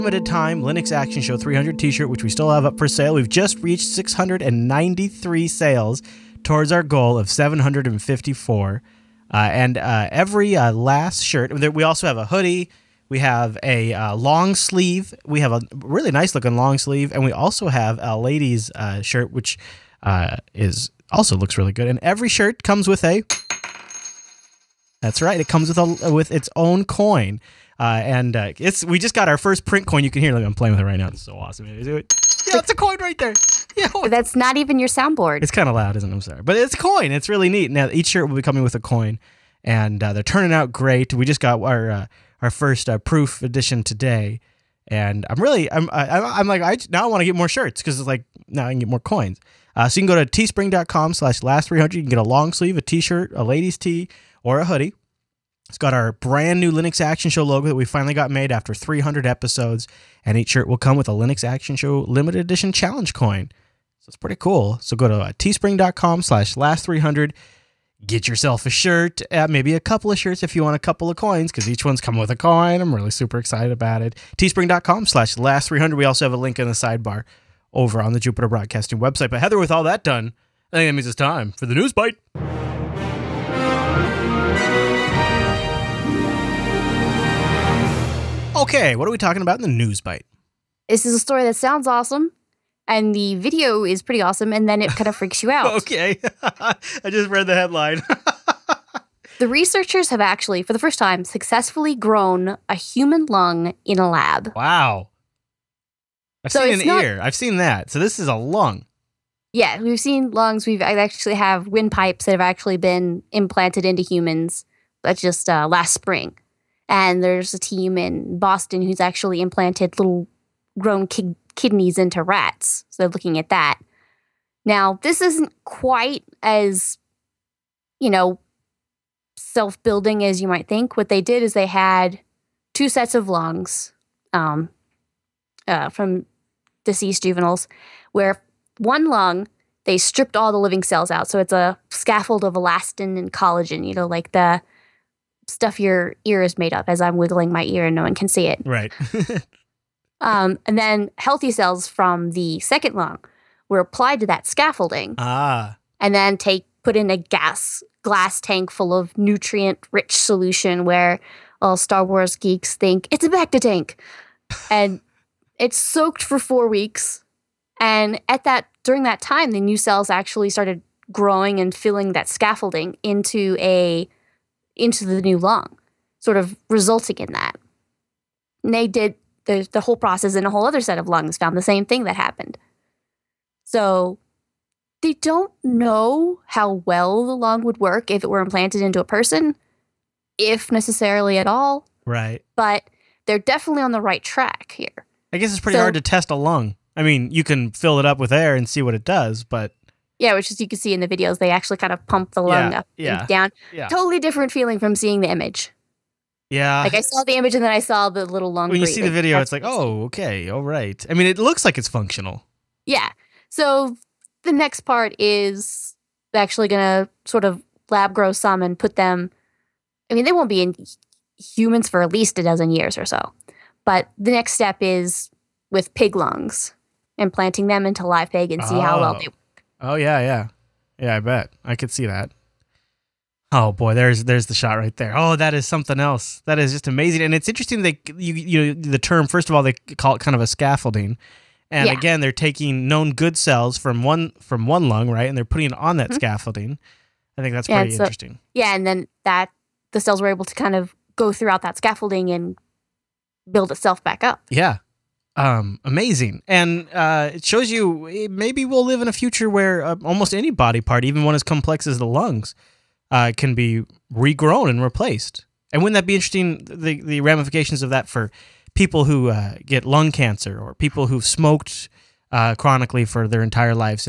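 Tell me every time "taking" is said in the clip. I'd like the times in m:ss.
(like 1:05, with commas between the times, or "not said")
4:02.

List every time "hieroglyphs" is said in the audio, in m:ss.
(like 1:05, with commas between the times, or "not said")
not said.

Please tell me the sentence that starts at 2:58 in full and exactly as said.
And they did the, the whole process in a whole other set of lungs, found the same thing that happened.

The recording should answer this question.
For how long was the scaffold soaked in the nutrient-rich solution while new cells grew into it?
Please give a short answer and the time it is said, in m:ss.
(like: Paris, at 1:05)
four weeks, at 2:46.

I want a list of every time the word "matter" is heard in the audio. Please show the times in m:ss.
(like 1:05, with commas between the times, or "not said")
not said.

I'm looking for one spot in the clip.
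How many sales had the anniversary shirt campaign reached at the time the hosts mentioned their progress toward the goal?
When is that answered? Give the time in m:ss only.
0:03.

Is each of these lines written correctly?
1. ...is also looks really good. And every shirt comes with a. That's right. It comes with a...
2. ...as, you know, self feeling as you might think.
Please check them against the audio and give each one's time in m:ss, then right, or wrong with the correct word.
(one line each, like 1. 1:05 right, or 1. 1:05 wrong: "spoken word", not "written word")
1. 0:20 right
2. 2:06 wrong: "building", not "feeling".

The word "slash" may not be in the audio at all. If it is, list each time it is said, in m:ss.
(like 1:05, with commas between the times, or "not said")
0:51, 1:06, 1:15.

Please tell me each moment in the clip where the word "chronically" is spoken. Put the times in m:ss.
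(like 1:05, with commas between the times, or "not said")
4:32.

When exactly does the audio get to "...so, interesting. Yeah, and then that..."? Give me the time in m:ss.
4:07.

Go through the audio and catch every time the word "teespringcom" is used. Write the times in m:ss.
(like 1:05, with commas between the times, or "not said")
0:50, 1:05, 1:14.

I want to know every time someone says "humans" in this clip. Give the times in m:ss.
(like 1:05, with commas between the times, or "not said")
1:42, 1:54, 3:41.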